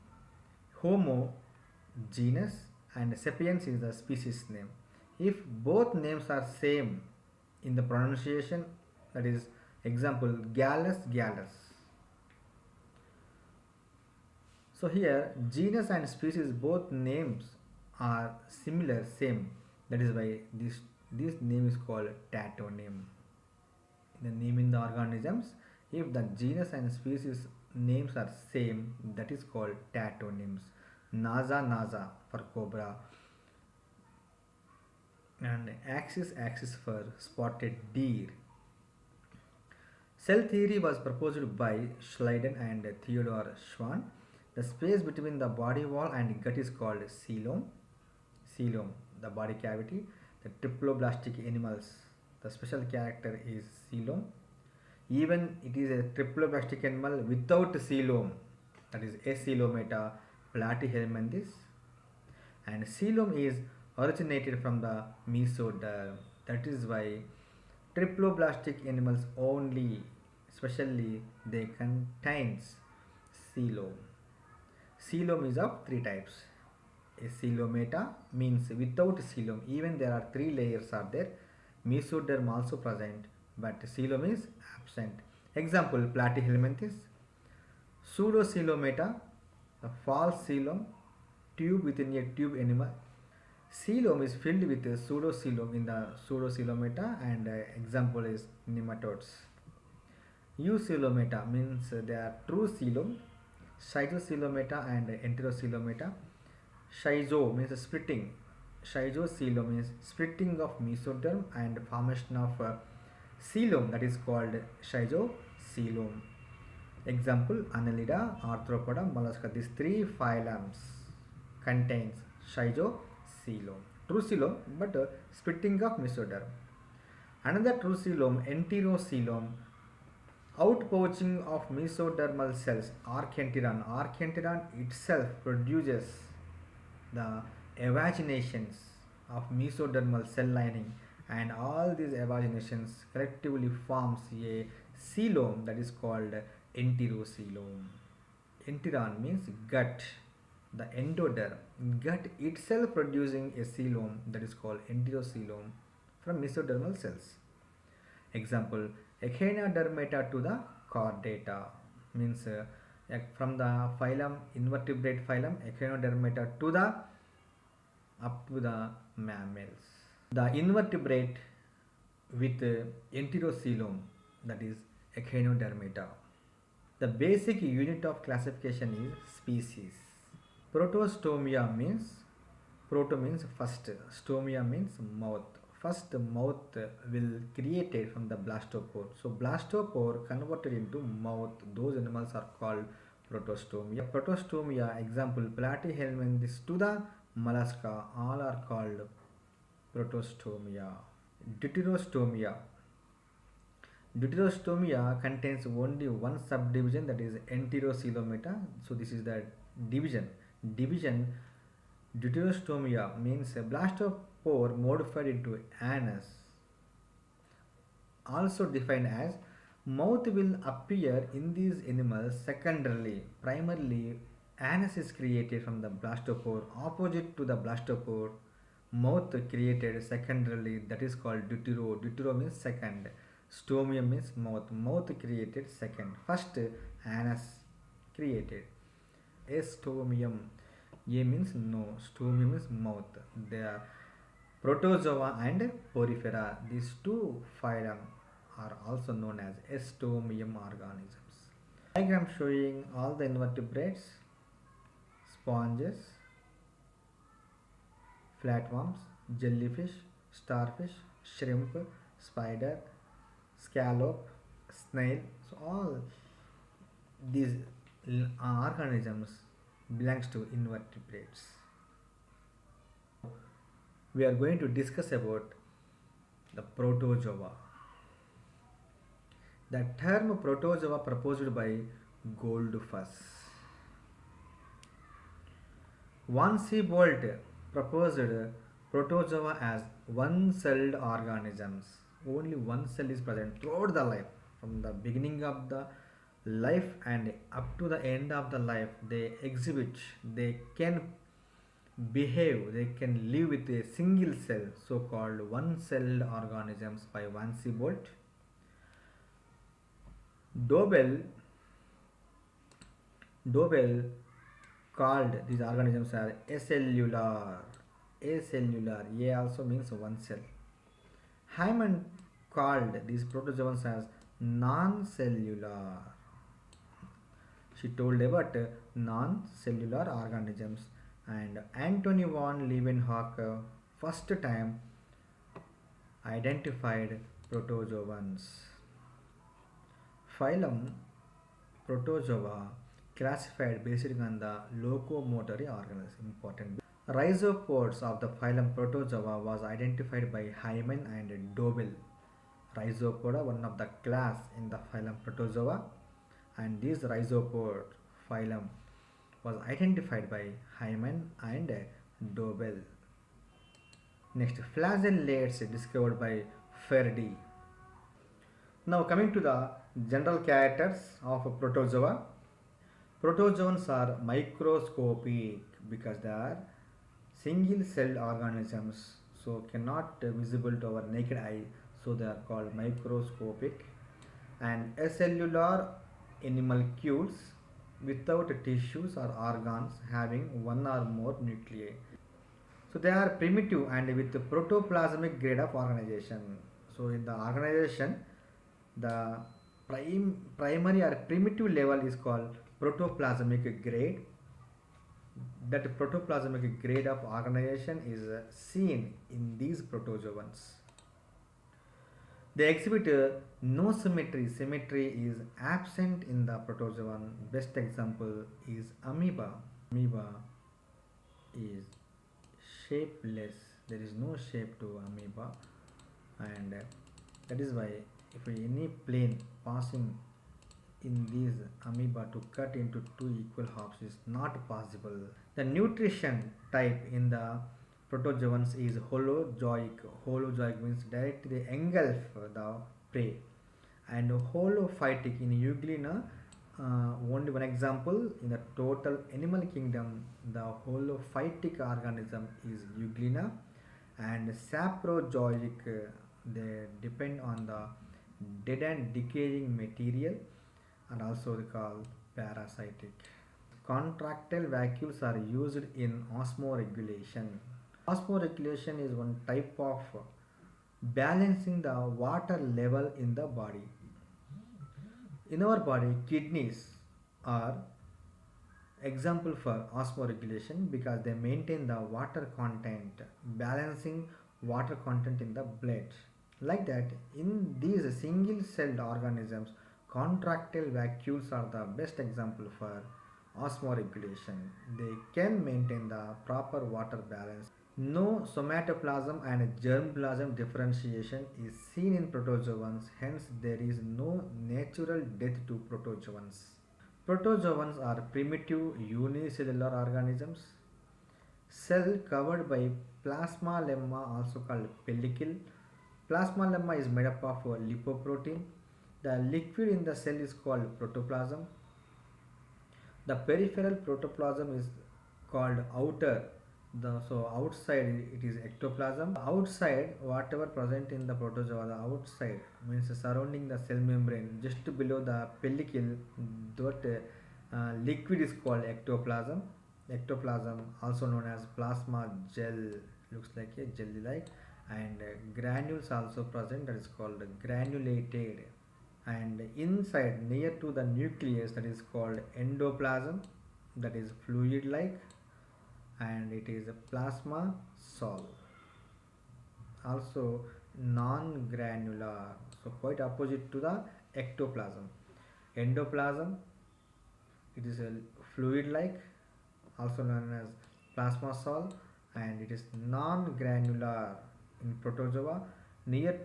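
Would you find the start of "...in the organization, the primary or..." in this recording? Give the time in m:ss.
6:37.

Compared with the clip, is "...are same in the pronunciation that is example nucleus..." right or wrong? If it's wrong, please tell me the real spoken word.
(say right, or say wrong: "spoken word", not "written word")
wrong: "gallus", not "nucleus".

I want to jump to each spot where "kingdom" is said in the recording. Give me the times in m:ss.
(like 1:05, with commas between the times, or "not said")
7:29.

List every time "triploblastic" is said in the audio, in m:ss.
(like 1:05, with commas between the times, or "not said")
0:50, 0:56, 1:07.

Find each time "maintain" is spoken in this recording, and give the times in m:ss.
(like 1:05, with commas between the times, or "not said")
8:01, 8:15.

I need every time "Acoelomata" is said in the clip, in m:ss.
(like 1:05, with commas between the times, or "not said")
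0:59.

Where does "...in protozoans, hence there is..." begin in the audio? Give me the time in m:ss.
8:22.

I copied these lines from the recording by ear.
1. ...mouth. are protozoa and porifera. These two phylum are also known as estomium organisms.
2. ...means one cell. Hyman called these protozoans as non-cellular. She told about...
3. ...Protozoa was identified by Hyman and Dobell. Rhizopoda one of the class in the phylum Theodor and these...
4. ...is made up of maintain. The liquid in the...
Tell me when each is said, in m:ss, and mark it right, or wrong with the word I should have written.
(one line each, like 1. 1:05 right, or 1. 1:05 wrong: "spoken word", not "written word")
1. 4:02 right
2. 5:19 right
3. 5:48 wrong: "Protozoa", not "Theodor"
4. 8:36 wrong: "lipoprotein", not "maintain".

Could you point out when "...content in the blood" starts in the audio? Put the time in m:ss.
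8:05.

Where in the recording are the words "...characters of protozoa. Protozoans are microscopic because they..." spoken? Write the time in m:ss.
6:10.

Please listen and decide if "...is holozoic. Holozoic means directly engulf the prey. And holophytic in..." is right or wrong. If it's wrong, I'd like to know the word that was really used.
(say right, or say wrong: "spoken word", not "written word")
right.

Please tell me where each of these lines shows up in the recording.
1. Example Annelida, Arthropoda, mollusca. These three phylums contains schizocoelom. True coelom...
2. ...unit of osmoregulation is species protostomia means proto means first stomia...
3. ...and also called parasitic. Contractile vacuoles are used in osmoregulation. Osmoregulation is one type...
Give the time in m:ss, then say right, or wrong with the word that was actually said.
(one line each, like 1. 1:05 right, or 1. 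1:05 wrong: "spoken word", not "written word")
1. 1:57 right
2. 2:57 wrong: "classification", not "osmoregulation"
3. 7:41 right.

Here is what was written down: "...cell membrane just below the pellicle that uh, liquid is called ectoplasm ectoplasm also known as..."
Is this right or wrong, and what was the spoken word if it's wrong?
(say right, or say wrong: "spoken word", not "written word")
right.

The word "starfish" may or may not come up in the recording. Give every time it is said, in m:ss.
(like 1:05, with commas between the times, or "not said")
4:20.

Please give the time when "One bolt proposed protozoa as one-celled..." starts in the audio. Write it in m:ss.
4:46.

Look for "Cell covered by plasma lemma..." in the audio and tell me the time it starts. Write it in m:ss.
8:31.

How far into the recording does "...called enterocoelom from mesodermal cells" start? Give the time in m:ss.
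2:34.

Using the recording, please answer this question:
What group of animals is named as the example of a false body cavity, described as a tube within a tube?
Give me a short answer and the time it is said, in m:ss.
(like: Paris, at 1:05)
Nematodes, at 1:38.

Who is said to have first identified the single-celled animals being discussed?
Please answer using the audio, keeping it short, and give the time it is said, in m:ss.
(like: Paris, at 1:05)
Antony von Leeuwenhoek, at 5:31.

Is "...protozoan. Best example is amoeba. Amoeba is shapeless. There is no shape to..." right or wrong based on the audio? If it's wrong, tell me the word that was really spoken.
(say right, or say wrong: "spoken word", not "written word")
right.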